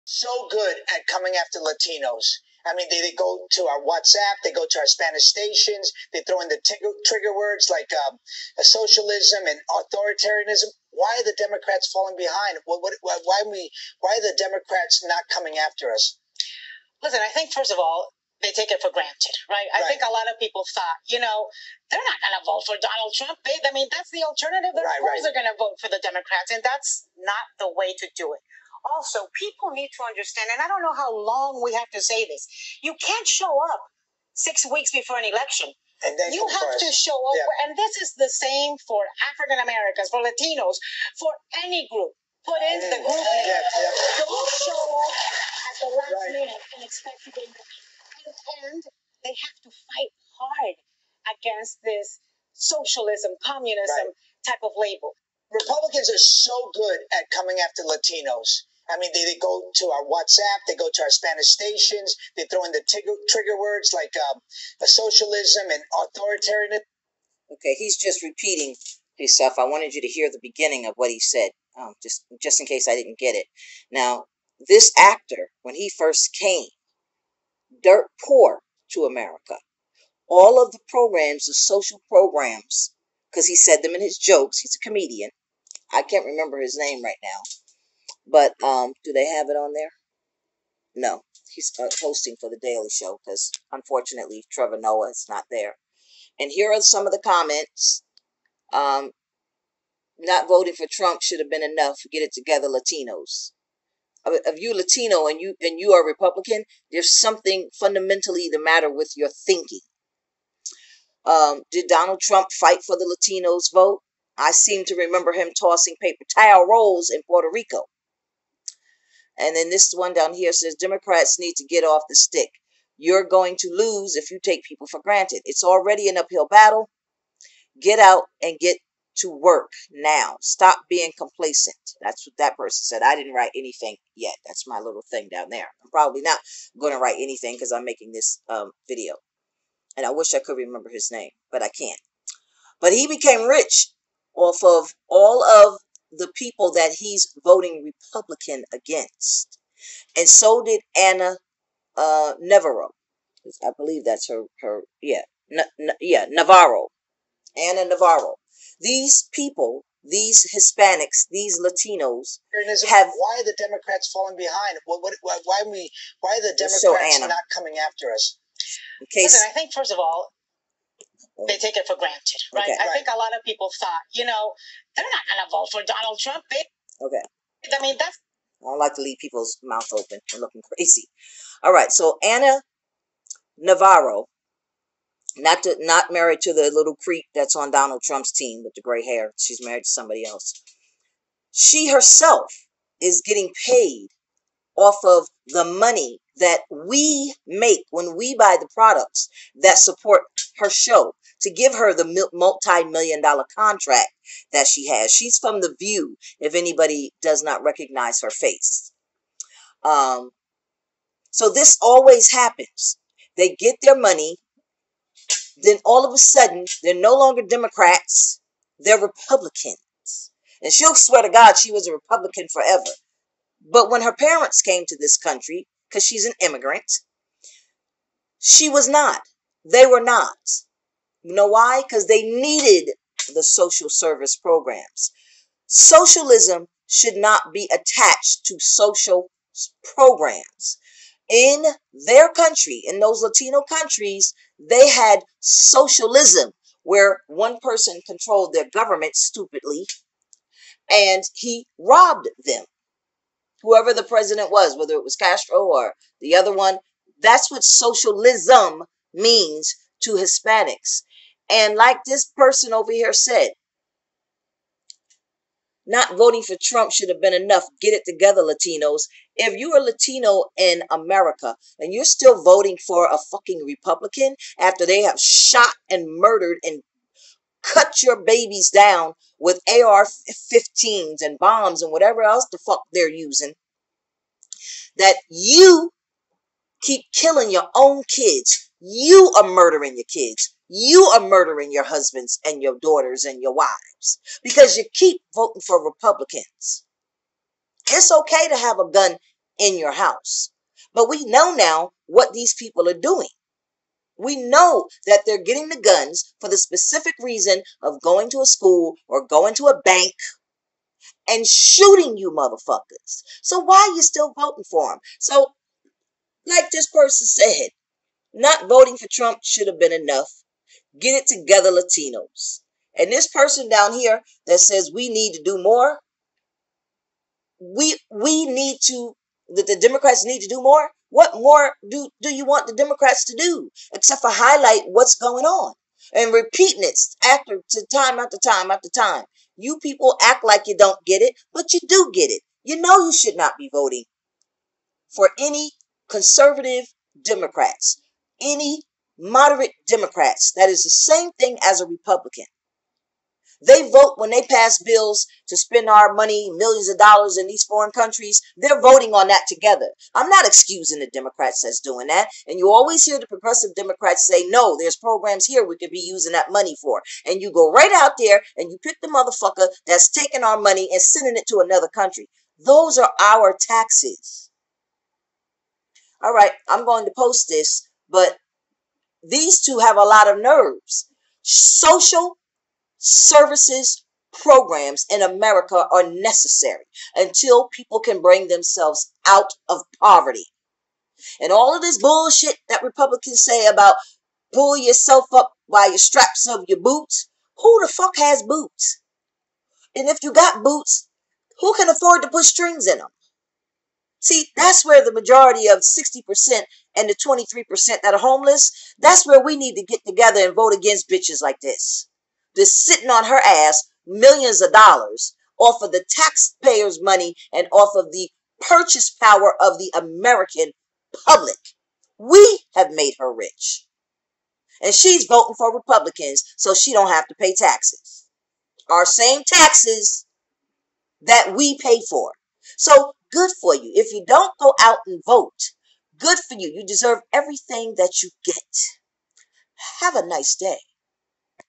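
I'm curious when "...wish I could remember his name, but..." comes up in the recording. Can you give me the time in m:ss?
2:20.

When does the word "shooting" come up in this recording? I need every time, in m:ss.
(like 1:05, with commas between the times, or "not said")
5:11.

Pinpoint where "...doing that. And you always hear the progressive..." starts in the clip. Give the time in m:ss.
6:01.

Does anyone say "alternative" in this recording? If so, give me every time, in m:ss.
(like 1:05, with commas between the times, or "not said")
0:24.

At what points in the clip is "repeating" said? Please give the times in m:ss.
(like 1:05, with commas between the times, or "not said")
1:08, 5:36.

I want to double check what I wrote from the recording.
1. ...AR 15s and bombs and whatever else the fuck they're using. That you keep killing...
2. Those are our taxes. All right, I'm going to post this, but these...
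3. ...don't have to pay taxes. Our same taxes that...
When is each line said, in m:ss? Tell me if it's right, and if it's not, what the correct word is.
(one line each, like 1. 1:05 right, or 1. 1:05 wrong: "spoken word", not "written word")
1. 4:39 right
2. 6:12 right
3. 7:06 right.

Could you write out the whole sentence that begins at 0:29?
Also, people need to understand, and I don't know how long we have to say this.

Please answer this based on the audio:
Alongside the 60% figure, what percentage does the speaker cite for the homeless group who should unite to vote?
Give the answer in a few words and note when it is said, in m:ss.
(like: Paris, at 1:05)
23%, at 6:47.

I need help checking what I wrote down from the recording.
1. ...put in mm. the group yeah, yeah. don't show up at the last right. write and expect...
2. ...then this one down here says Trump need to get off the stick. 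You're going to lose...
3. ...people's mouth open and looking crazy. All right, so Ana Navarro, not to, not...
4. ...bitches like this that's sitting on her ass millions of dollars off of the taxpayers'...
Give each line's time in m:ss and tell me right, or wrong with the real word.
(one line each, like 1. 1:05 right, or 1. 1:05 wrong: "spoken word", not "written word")
1. 0:42 wrong: "minute", not "write"
2. 1:59 wrong: "Democrats", not "Trump"
3. 2:59 right
4. 6:51 right.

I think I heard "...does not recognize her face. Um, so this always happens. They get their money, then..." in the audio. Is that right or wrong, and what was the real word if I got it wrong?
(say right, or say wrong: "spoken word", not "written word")
right.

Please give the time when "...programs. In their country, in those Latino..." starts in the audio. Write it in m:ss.
3:59.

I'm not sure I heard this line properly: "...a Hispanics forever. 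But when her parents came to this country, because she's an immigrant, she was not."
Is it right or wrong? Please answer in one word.
wrong.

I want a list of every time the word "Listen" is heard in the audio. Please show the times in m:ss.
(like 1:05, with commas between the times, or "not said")
0:17, 2:49.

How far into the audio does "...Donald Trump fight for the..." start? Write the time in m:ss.
1:51.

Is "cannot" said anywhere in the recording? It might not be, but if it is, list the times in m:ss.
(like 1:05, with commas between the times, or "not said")
not said.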